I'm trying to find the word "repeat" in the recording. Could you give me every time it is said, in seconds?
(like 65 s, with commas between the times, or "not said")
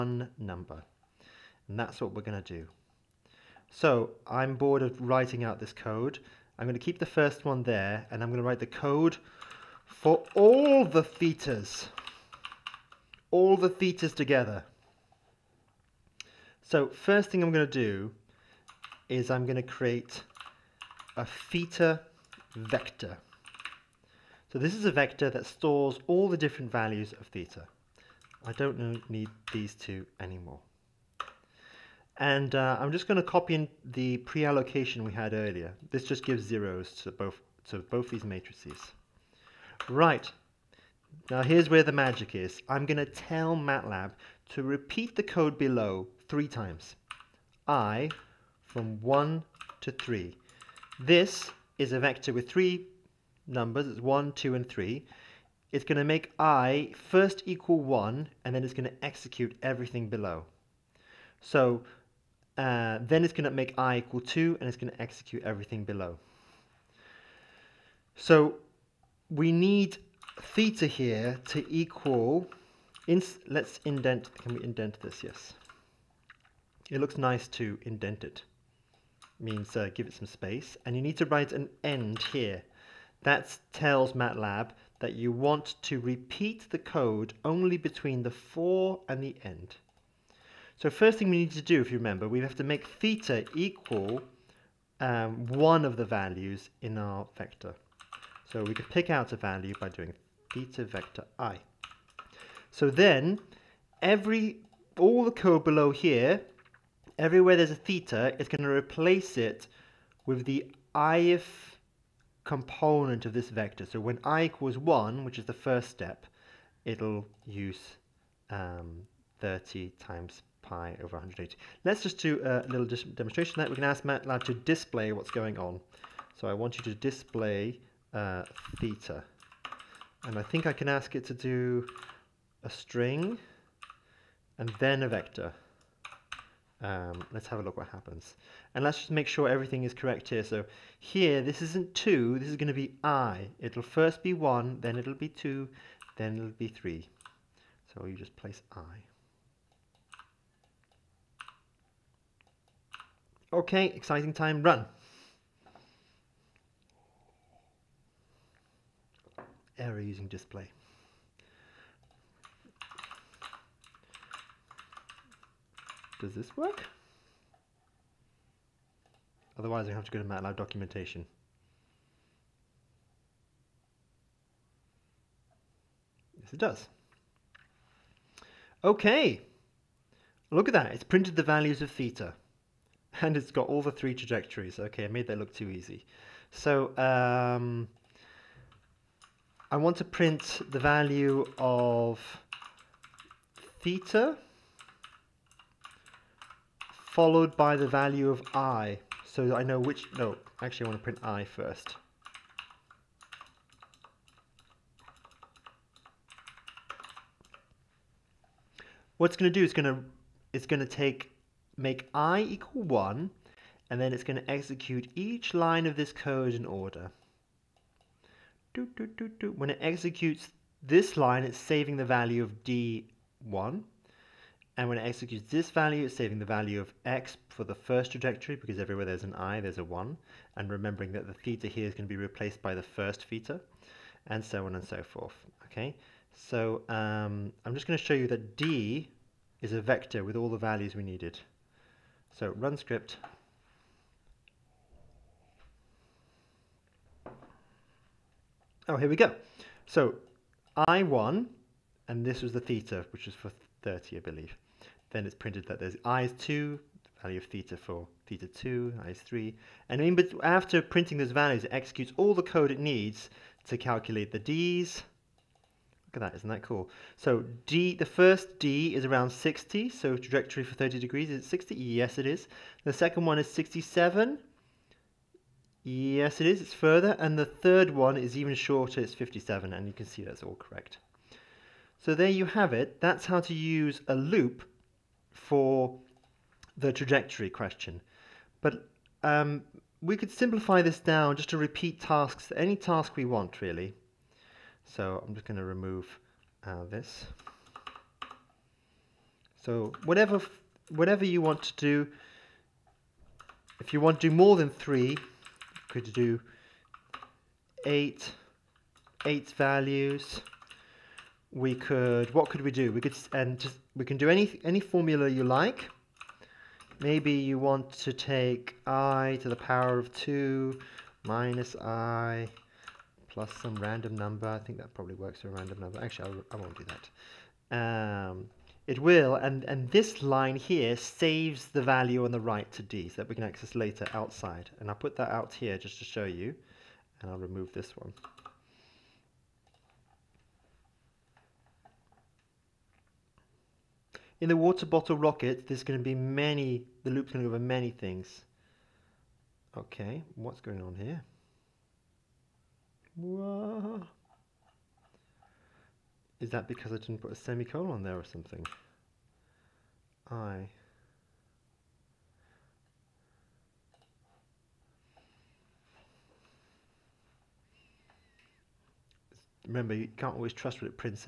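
44 s, 85 s, 291 s.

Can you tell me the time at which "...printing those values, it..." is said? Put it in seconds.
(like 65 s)
260 s.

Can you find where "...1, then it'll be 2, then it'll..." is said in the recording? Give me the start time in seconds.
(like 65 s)
144 s.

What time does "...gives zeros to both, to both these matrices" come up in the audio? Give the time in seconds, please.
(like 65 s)
36 s.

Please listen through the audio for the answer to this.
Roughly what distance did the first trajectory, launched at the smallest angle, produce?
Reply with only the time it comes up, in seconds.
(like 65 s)
269 s.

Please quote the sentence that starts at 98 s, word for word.
So we could pick out a value by doing theta vector i.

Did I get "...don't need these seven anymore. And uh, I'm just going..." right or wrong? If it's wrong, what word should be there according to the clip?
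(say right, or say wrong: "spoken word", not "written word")
wrong: "two", not "seven".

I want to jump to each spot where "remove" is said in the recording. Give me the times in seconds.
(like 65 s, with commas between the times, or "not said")
295 s, 337 s.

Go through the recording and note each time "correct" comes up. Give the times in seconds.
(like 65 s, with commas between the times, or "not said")
139 s, 280 s.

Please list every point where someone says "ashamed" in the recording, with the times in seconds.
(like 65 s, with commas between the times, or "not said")
not said.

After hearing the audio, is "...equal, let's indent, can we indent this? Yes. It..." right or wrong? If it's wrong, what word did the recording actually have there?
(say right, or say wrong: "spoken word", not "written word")
right.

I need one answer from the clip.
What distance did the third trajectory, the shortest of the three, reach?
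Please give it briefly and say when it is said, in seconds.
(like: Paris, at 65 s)
57, at 279 s.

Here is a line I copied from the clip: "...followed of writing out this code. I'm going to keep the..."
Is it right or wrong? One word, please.
wrong.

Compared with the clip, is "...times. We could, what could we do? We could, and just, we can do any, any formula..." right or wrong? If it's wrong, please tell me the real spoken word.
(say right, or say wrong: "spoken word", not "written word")
wrong: "values", not "times".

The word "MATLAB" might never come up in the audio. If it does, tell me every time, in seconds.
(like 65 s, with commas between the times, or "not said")
43 s, 84 s, 124 s, 170 s.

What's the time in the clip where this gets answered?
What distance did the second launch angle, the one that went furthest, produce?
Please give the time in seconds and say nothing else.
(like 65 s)
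273 s.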